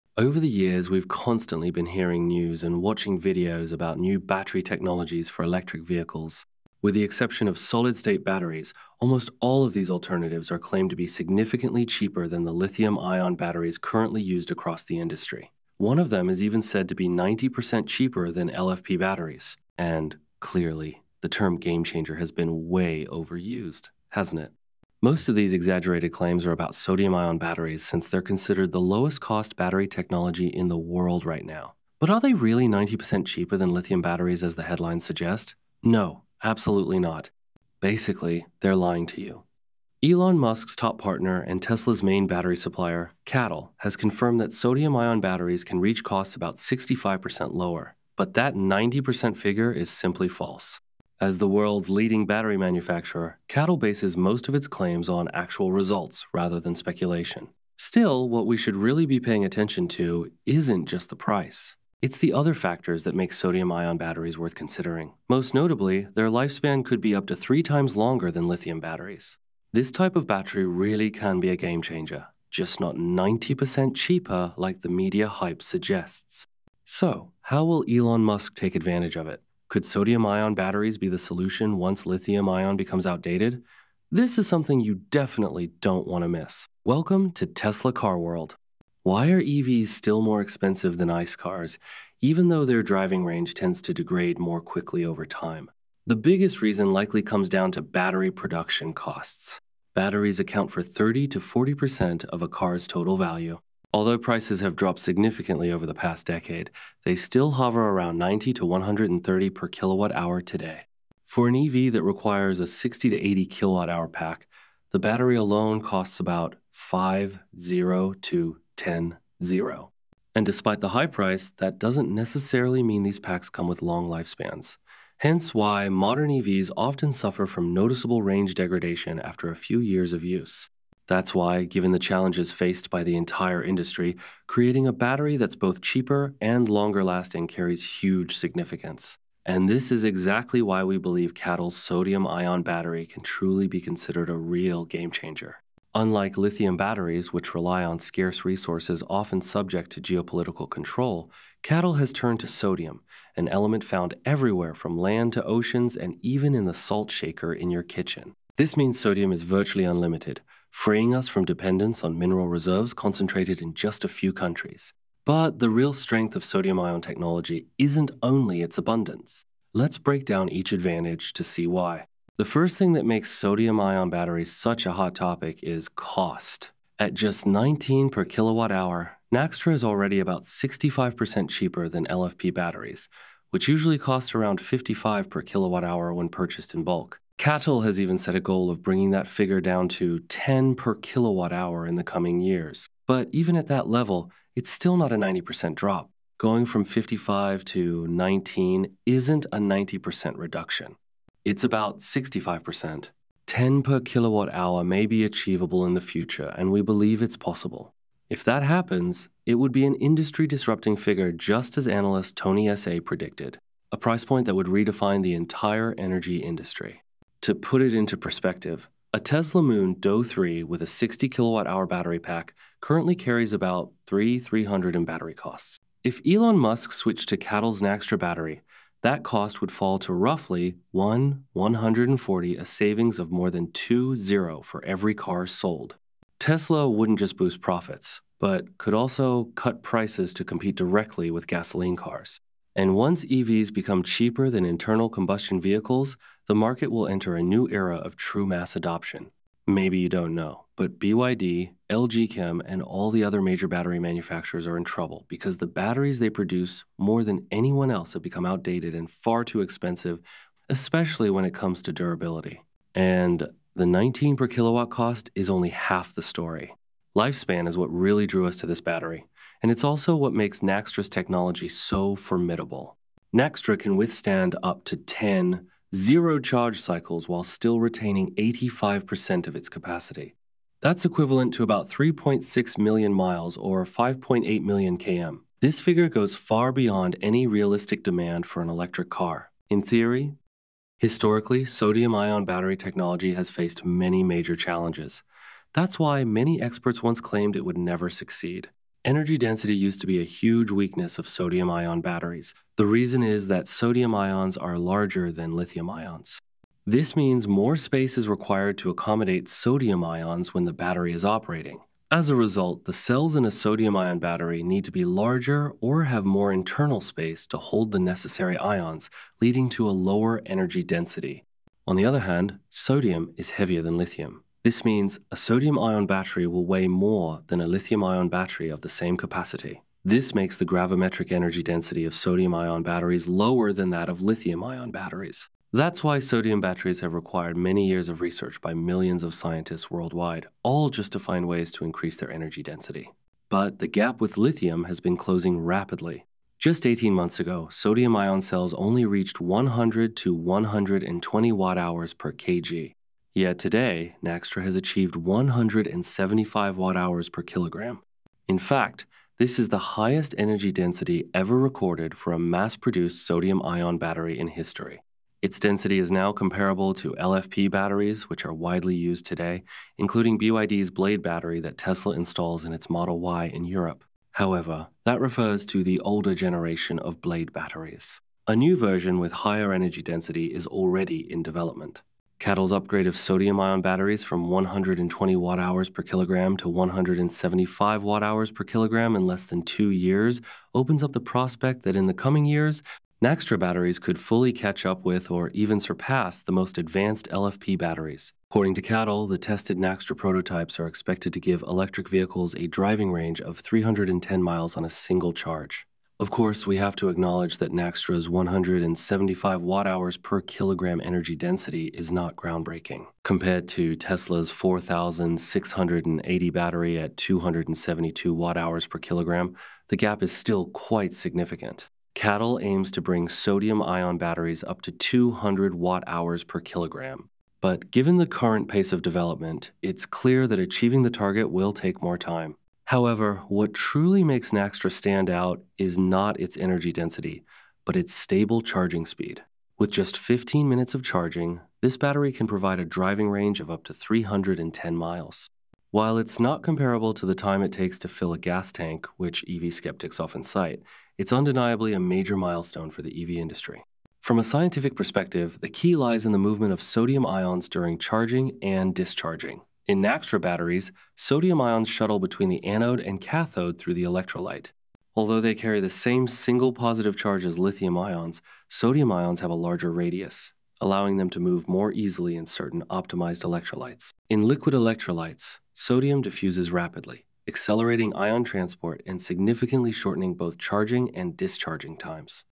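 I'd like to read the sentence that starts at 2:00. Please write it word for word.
And despite the high price, that doesn't necessarily mean these packs come with long lifespans.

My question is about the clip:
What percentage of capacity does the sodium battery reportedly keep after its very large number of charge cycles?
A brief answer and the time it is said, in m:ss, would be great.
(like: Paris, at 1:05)
85%, at 4:38.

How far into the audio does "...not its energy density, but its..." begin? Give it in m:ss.
7:15.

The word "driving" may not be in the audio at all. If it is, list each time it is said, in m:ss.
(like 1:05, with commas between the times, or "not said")
1:32, 6:42, 7:22.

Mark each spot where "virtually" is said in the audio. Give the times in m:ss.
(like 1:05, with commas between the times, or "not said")
2:39.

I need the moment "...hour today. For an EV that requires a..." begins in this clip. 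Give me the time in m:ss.
1:50.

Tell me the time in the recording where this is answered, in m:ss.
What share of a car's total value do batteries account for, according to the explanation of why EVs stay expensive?
1:40.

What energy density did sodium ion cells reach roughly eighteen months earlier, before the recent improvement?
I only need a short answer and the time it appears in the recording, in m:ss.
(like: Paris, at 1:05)
100 to 120 Wh/kg, at 5:49.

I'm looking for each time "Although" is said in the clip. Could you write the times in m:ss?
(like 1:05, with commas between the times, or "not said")
1:43, 7:45.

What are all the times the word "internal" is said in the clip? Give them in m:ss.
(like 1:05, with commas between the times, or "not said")
4:04, 5:16.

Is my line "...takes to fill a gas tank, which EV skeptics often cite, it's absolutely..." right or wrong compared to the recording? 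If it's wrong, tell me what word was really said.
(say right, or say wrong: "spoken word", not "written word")
wrong: "undeniably", not "absolutely".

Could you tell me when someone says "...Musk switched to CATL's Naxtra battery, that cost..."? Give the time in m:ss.
3:46.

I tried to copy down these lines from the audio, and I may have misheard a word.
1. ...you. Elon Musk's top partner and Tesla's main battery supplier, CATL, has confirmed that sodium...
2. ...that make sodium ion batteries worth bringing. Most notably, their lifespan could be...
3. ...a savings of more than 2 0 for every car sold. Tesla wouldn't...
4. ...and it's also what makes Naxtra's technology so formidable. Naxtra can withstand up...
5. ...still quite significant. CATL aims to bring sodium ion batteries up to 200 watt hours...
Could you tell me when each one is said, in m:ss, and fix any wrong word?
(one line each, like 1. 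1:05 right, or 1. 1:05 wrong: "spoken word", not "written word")
1. 0:39 right
2. 1:03 wrong: "considering", not "bringing"
3. 3:52 right
4. 4:29 right
5. 7:00 right.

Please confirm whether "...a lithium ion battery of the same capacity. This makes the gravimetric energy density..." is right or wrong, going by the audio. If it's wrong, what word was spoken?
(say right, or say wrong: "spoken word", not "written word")
right.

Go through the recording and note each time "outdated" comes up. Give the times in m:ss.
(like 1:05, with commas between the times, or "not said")
1:23, 4:18.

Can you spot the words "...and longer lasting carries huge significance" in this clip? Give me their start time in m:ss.
2:16.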